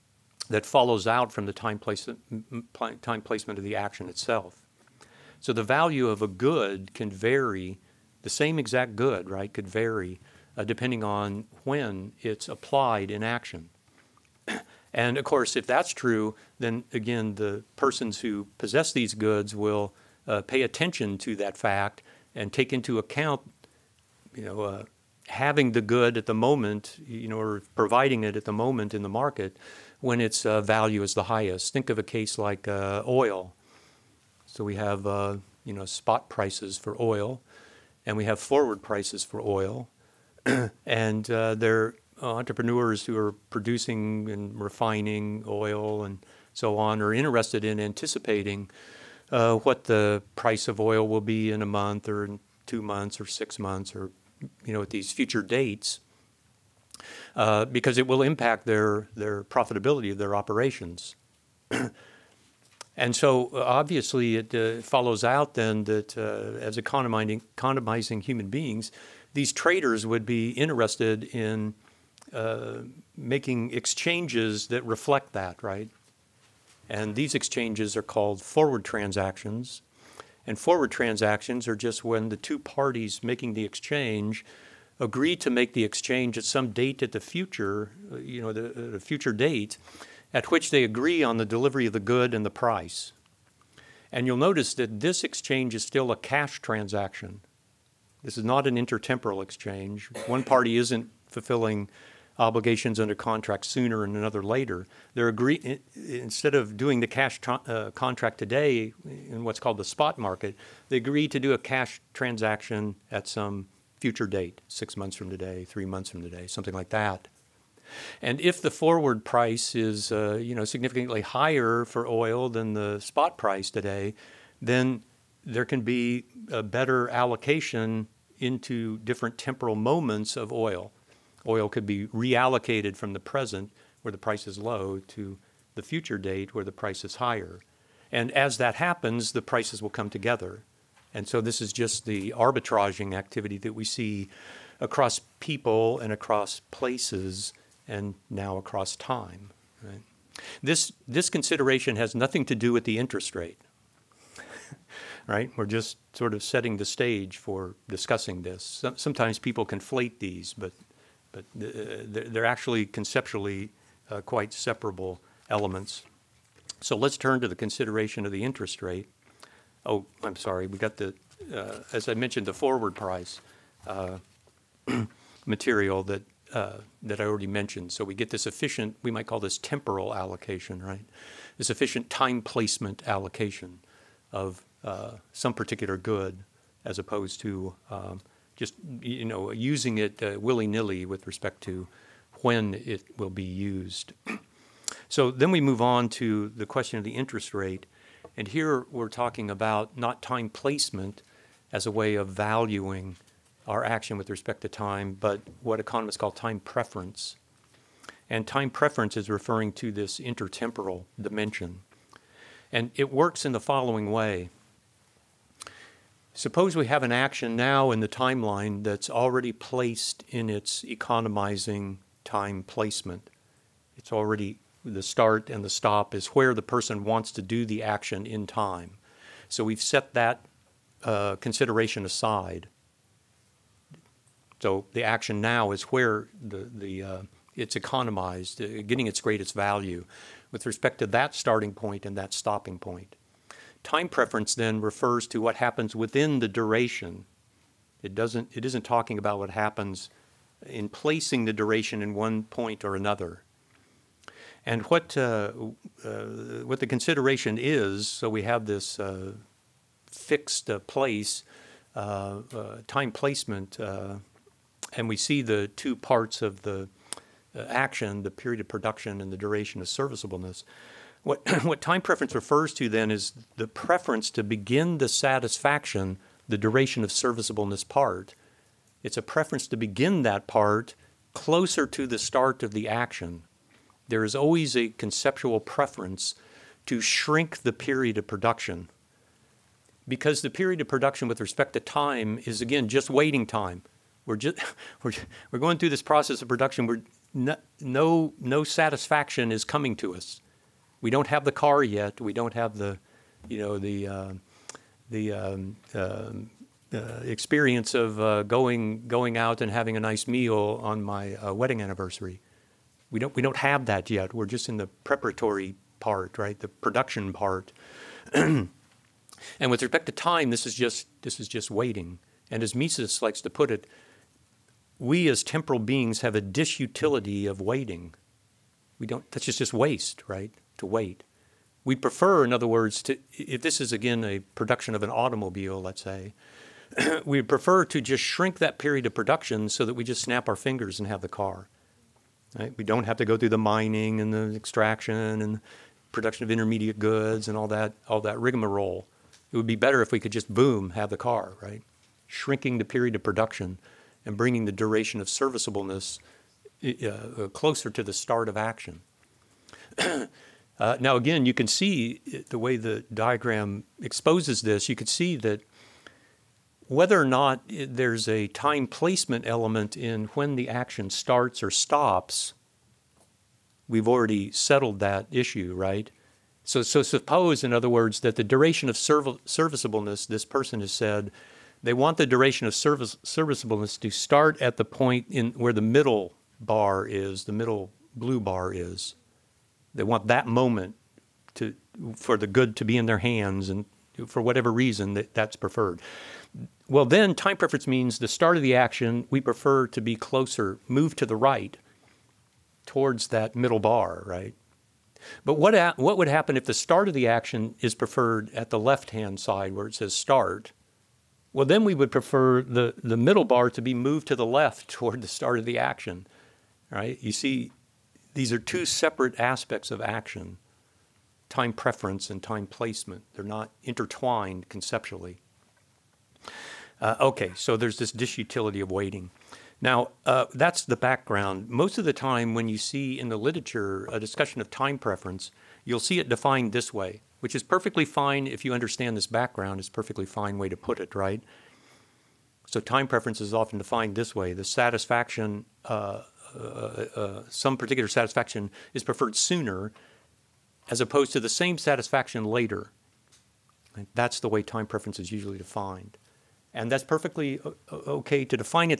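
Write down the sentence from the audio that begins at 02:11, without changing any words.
Oil could be reallocated from the present, where the price is low, to the future date, where the price is higher.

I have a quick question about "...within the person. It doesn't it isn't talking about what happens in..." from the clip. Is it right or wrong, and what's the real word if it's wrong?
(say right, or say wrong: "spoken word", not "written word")
wrong: "duration", not "person".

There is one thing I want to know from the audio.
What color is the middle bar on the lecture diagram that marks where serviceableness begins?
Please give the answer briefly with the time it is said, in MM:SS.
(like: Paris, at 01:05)
blue, at 06:28.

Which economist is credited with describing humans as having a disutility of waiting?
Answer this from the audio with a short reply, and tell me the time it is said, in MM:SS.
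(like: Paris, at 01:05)
Mises, at 05:22.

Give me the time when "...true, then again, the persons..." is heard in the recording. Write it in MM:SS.
00:15.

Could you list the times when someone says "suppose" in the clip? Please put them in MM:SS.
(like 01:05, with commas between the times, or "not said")
03:36, 06:17.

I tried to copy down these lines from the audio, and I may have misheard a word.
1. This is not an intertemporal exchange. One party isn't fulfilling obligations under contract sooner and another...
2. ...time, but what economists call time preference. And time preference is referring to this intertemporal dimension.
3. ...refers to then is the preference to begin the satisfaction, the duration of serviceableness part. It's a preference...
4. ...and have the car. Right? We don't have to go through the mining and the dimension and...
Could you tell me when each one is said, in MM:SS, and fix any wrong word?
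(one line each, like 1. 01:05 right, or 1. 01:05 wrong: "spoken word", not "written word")
1. 01:38 right
2. 03:24 right
3. 04:32 right
4. 05:40 wrong: "extraction", not "dimension".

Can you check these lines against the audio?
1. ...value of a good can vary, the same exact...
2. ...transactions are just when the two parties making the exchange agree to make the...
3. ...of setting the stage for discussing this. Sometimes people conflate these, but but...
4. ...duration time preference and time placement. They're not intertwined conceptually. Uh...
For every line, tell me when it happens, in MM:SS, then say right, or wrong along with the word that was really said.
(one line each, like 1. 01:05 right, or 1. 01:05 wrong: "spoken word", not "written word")
1. 00:05 right
2. 01:20 right
3. 02:36 right
4. 06:59 wrong: "action", not "duration".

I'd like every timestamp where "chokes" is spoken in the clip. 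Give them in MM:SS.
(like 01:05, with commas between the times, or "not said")
not said.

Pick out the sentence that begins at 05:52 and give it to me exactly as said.
Shrinking the period of production and bringing the duration of serviceableness uh, closer to the start of action.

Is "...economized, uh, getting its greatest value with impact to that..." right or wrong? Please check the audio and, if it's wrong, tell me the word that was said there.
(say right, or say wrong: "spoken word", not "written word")
wrong: "respect", not "impact".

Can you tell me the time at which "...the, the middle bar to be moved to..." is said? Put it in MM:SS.
06:52.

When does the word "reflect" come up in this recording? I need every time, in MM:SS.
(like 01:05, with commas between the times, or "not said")
01:14.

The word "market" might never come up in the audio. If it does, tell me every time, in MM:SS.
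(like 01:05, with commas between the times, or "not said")
00:29, 01:50.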